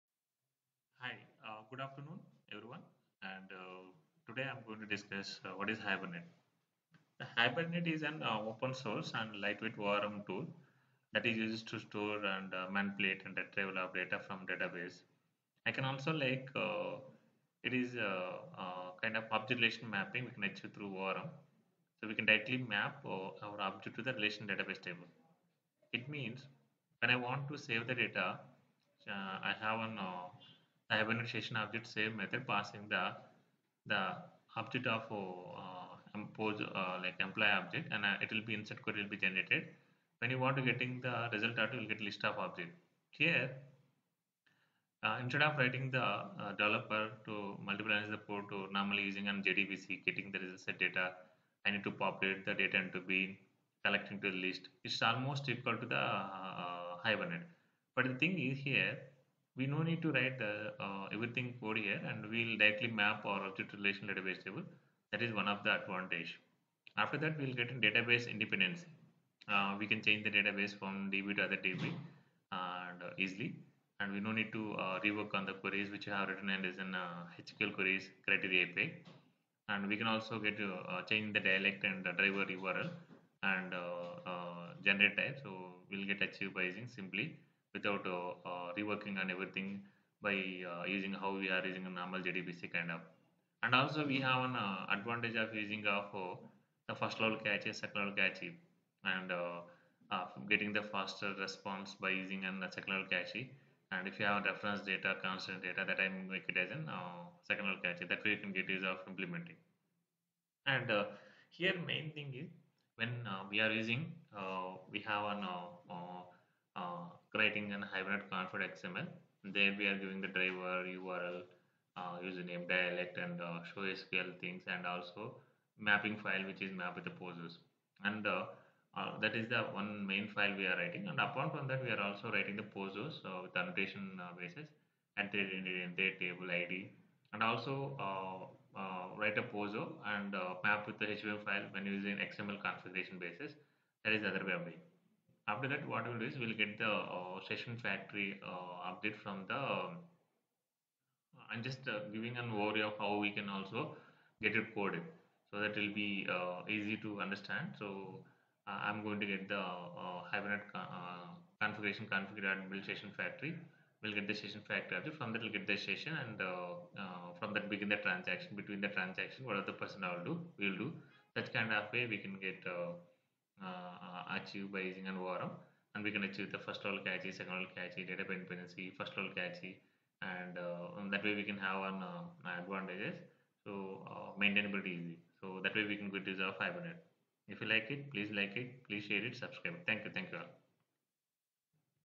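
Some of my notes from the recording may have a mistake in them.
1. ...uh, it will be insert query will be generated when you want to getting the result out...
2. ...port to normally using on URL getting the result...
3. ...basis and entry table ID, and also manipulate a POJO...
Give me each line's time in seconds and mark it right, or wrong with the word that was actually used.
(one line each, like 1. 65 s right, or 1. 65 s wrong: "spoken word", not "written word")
1. 38 s right
2. 48 s wrong: "JDBC", not "URL"
3. 134 s wrong: "write", not "manipulate".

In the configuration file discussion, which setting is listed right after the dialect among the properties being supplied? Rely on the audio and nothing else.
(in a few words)
show SQL.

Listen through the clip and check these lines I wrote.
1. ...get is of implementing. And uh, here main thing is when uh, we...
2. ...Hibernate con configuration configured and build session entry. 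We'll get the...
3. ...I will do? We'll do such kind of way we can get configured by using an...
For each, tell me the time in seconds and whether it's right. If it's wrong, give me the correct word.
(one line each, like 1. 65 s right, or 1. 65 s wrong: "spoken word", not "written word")
1. 108 s right
2. 160 s wrong: "factory", not "entry"
3. 170 s wrong: "achieved", not "configured".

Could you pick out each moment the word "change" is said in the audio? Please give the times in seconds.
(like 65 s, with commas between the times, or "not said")
70 s, 81 s.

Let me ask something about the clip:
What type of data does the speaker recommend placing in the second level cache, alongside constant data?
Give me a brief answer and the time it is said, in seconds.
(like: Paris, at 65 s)
reference data, at 104 s.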